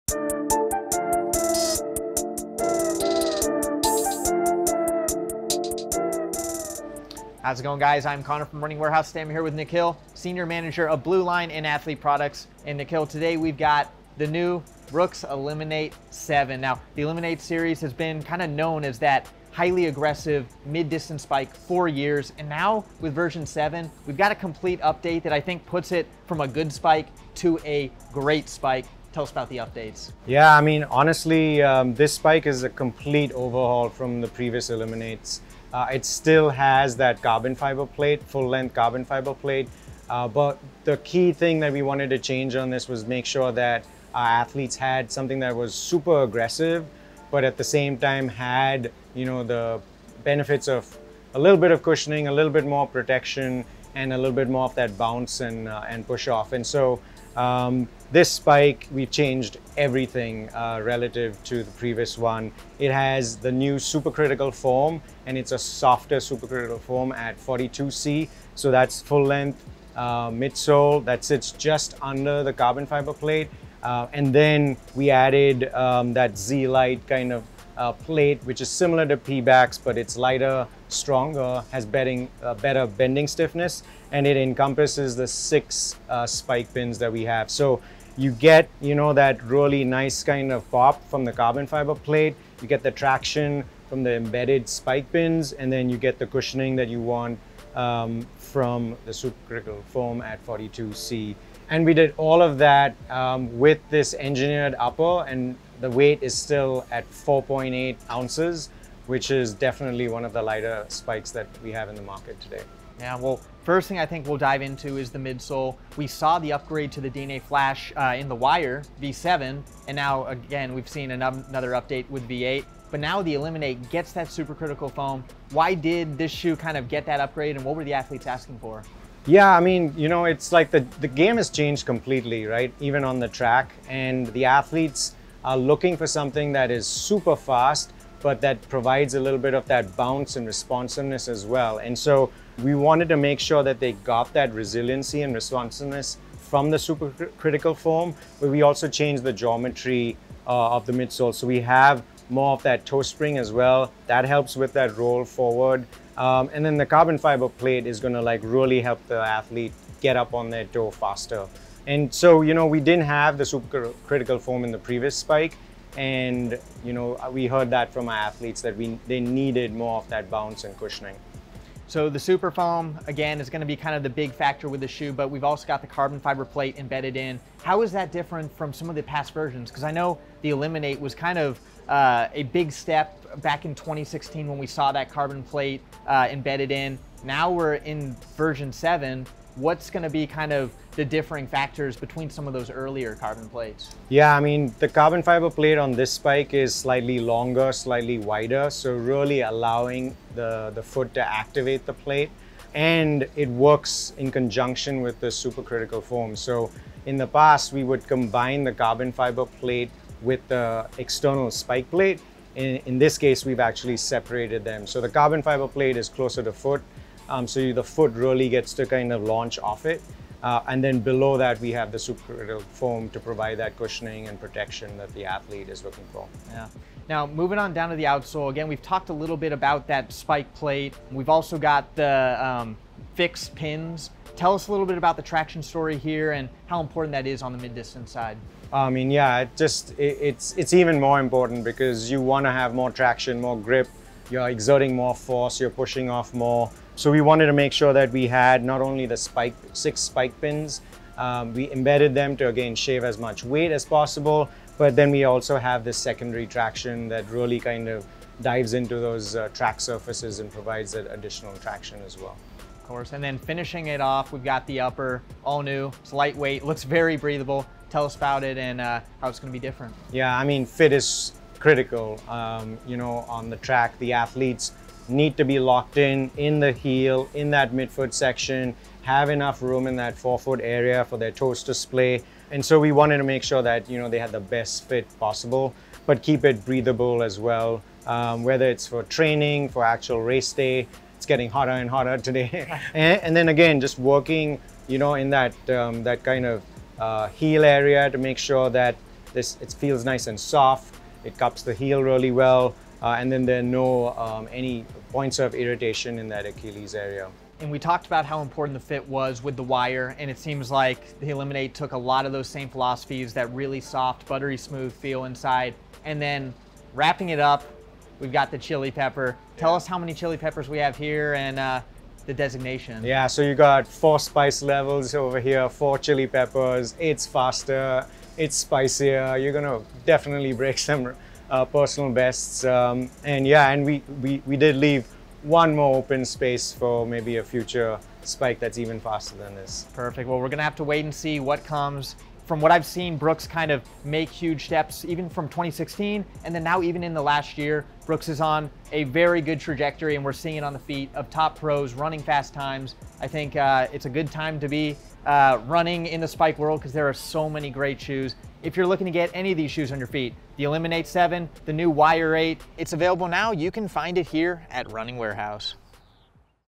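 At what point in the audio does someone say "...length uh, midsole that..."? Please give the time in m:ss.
1:09.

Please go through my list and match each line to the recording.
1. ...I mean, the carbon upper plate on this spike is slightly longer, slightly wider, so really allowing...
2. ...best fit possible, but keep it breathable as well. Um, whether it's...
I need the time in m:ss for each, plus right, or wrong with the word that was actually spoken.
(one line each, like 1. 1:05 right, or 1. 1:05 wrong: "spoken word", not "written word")
1. 3:14 wrong: "fiber", not "upper"
2. 4:44 right.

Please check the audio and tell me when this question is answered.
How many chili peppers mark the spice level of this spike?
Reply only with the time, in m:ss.
5:25.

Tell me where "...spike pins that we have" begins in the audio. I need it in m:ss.
1:26.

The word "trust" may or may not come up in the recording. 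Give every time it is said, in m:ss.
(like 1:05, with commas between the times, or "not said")
not said.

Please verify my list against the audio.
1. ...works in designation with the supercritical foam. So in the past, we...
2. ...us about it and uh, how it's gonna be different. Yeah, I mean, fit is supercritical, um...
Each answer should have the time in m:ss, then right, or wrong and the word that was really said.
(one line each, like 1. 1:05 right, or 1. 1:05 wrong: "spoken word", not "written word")
1. 3:23 wrong: "conjunction", not "designation"
2. 4:28 wrong: "critical", not "supercritical".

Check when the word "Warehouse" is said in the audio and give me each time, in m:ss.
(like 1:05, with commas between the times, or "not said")
0:08, 6:05.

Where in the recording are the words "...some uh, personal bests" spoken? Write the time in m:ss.
5:30.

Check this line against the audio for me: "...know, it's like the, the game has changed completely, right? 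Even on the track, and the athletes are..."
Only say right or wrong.
right.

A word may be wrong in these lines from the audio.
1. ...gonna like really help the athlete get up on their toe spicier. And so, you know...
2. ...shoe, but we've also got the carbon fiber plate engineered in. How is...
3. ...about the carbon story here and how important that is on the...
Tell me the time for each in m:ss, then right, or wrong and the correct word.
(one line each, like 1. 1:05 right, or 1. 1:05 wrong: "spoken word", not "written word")
1. 2:37 wrong: "faster", not "spicier"
2. 2:54 wrong: "embedded", not "engineered"
3. 3:54 wrong: "traction", not "carbon".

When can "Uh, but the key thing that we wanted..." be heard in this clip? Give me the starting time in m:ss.
0:40.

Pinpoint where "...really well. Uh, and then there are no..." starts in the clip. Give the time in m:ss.
5:02.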